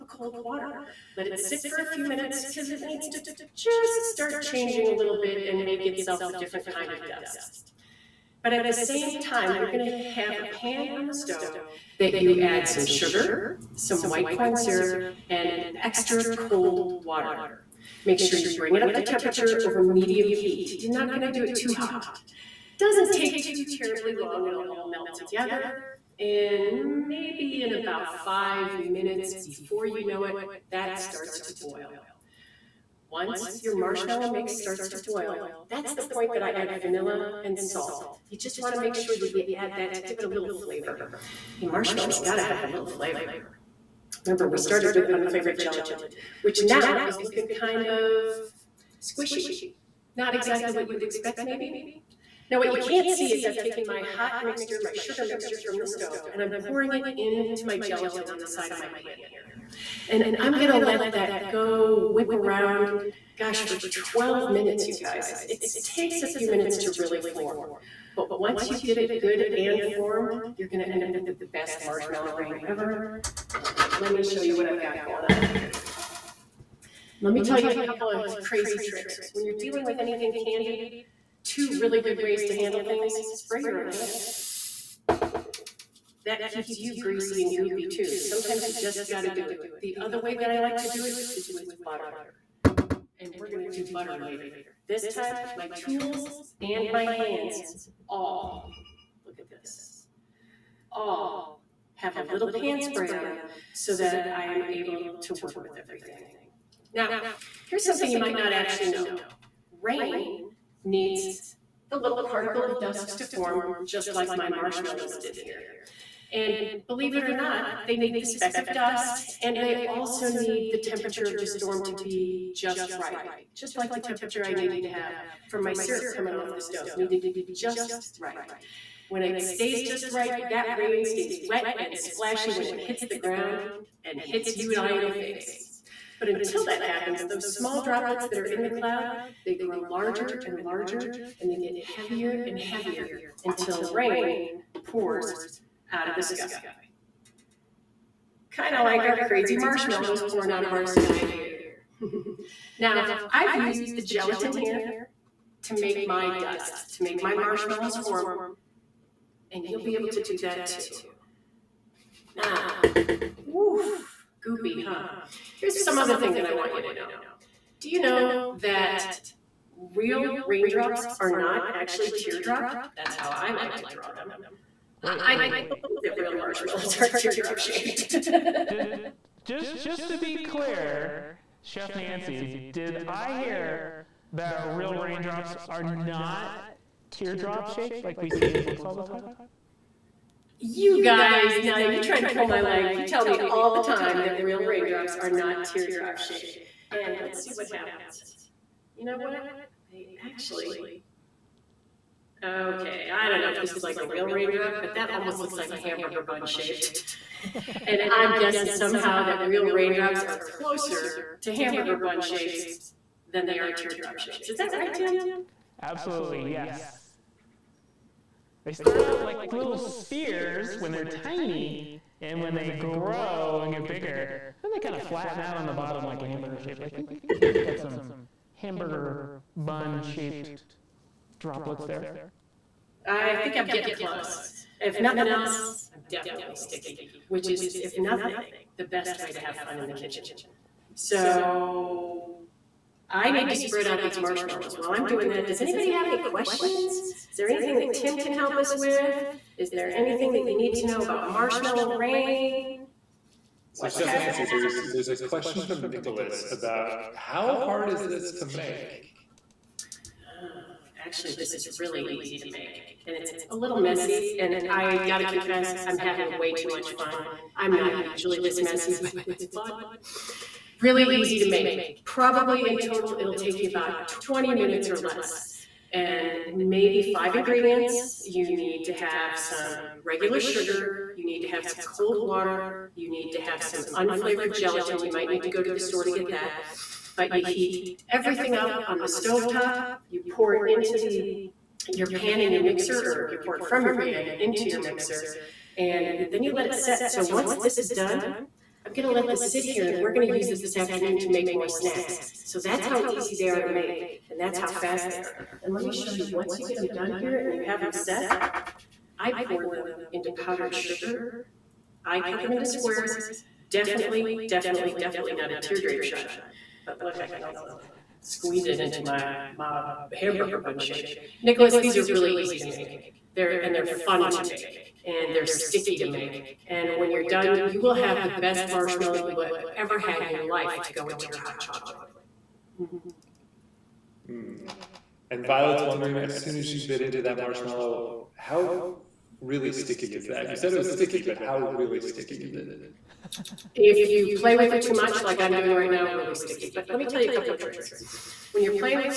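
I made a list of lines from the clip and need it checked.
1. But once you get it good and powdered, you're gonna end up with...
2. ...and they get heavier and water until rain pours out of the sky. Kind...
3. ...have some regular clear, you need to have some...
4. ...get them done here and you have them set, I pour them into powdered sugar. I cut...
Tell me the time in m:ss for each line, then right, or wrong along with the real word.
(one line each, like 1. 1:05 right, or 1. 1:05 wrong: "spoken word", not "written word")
1. 1:08 wrong: "formed", not "powdered"
2. 2:21 wrong: "heavier", not "water"
3. 4:38 wrong: "sugar", not "clear"
4. 5:06 right.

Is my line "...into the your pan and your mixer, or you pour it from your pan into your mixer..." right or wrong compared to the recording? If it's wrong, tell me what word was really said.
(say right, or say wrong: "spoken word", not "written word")
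right.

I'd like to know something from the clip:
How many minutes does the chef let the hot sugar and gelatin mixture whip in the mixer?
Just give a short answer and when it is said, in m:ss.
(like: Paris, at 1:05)
12 minutes, at 1:03.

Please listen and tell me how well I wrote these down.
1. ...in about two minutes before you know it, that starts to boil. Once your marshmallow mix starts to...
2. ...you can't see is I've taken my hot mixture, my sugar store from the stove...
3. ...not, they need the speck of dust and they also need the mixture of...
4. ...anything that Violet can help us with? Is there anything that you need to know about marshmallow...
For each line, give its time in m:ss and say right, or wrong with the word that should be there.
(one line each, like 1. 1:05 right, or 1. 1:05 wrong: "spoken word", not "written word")
1. 0:27 wrong: "five", not "two"
2. 0:52 wrong: "mixture", not "store"
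3. 1:57 wrong: "temperature", not "mixture"
4. 4:07 wrong: "Tim", not "Violet".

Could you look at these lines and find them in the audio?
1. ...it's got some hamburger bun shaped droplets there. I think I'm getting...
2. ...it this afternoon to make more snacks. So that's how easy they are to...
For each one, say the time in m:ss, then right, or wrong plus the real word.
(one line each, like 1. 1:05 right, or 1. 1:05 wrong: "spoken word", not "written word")
1. 3:47 right
2. 5:00 right.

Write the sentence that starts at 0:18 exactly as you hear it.
Make sure you bring it up to temperature over medium heat.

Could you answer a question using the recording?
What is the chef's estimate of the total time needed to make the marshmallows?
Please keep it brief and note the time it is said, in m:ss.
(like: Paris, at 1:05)
20 minutes or less, at 4:34.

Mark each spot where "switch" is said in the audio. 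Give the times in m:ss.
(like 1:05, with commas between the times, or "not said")
not said.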